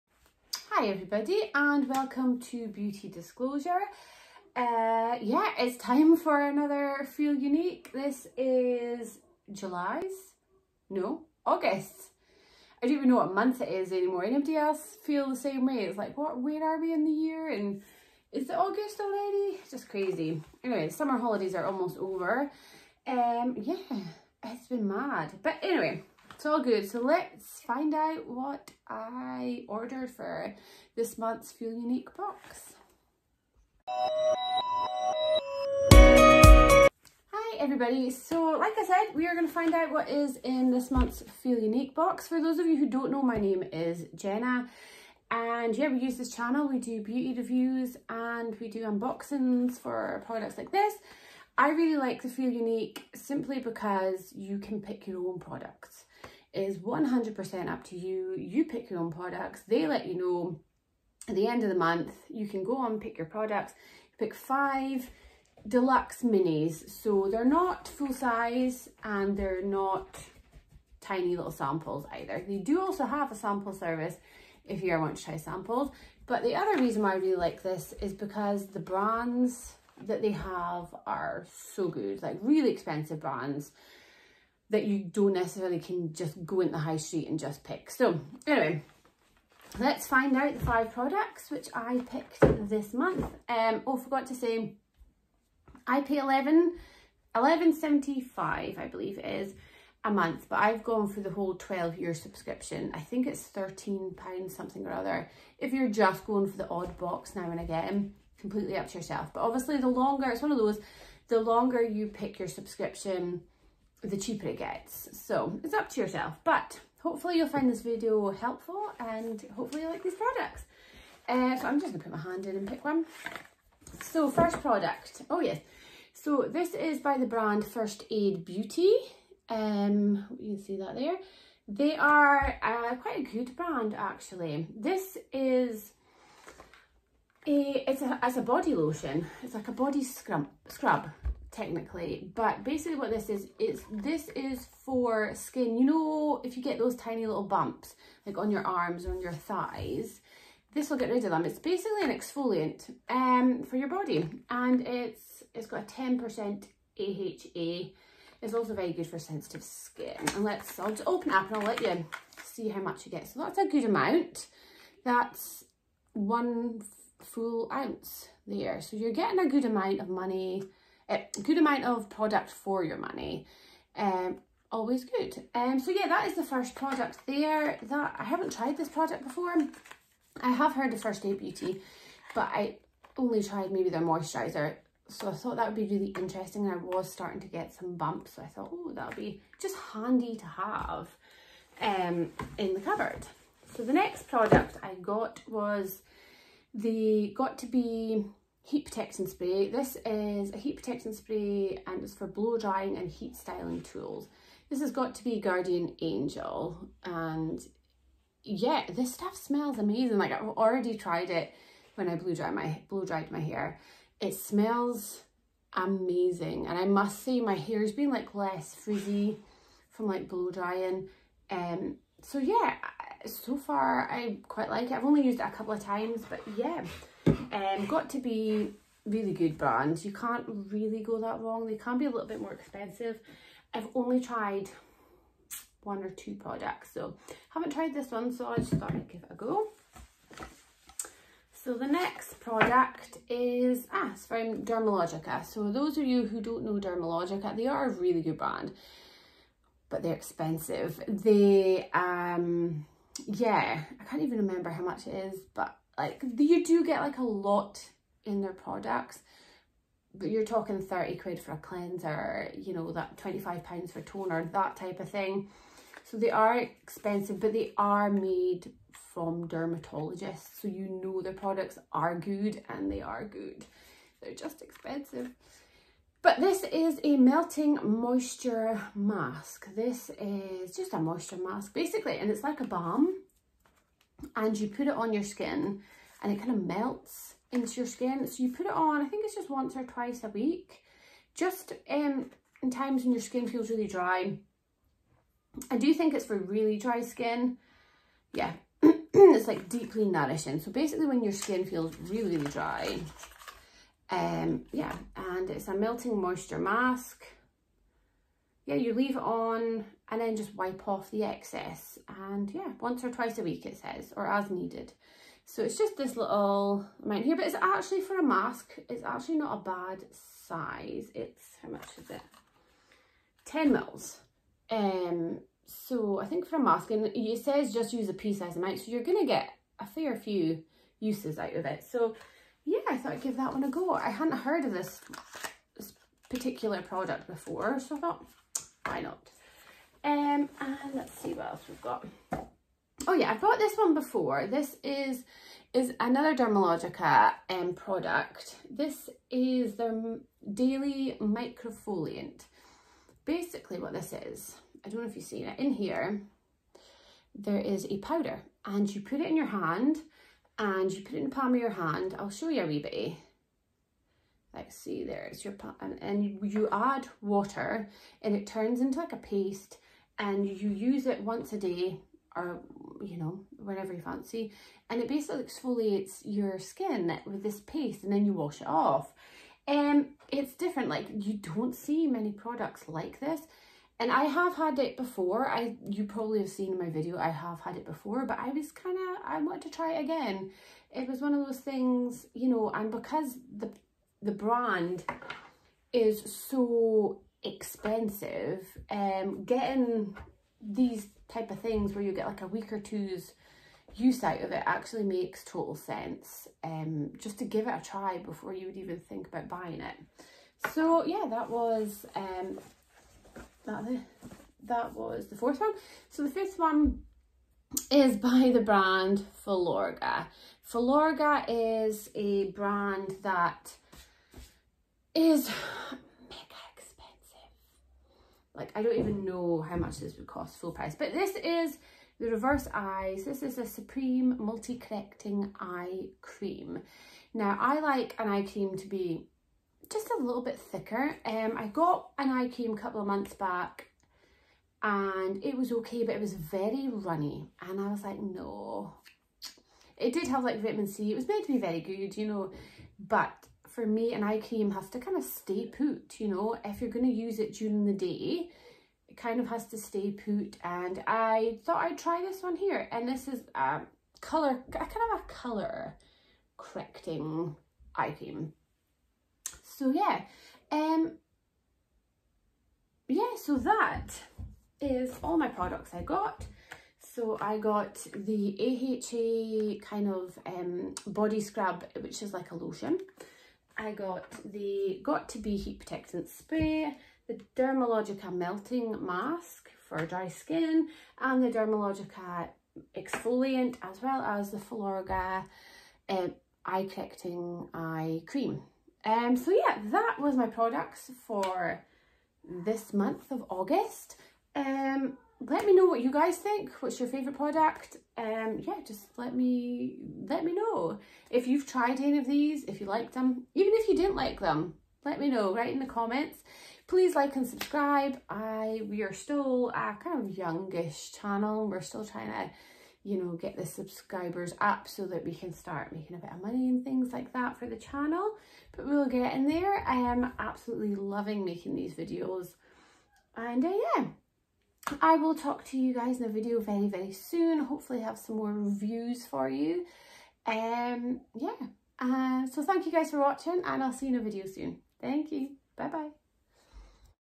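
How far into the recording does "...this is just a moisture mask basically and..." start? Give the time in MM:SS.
04:39.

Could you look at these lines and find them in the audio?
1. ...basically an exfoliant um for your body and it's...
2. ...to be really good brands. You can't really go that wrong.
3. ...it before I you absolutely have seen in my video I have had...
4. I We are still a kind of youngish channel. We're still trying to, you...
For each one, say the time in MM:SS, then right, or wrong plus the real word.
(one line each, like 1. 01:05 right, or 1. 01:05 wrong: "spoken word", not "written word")
1. 02:31 right
2. 03:48 right
3. 06:24 wrong: "probably", not "absolutely"
4. 08:38 right.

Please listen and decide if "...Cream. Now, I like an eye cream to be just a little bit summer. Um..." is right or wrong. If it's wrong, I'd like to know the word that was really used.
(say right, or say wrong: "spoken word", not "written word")
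wrong: "thicker", not "summer".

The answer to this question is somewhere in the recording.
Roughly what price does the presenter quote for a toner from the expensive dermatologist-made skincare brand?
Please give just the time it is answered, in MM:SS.
04:23.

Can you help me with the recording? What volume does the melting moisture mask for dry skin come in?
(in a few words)
10 ml.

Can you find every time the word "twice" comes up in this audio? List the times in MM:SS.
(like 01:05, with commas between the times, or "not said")
04:49, 05:13.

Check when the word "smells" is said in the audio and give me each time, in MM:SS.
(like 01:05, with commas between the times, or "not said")
03:29, 03:34.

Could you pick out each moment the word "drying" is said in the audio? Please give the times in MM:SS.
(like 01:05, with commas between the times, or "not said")
03:22, 03:40.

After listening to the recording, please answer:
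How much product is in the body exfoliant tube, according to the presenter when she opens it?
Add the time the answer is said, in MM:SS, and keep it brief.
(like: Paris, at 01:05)
1 ounce, at 02:46.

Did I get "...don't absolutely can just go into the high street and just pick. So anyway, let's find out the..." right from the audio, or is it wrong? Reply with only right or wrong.
wrong.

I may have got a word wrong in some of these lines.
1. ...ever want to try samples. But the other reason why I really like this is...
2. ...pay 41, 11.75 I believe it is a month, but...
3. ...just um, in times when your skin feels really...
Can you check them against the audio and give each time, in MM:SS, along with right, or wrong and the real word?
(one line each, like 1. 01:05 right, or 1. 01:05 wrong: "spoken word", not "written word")
1. 01:14 right
2. 01:36 wrong: "11", not "41"
3. 04:51 right.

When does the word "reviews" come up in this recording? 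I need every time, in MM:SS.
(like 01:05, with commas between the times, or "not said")
00:47, 08:58.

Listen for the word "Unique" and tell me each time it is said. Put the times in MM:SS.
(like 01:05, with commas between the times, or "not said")
00:07, 00:31, 00:41, 00:52.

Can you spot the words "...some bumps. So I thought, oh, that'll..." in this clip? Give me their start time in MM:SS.
03:07.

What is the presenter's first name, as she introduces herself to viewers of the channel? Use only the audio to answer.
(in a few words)
Jenna.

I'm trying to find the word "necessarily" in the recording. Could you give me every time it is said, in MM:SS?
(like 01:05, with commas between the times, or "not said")
01:25.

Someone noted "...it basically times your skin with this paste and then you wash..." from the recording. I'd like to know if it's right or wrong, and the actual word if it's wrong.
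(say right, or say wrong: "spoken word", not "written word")
wrong: "exfoliates", not "times".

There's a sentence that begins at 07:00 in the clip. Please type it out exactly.
Filorga is a brand that is mega expensive.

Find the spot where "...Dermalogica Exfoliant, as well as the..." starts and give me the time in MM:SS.
08:11.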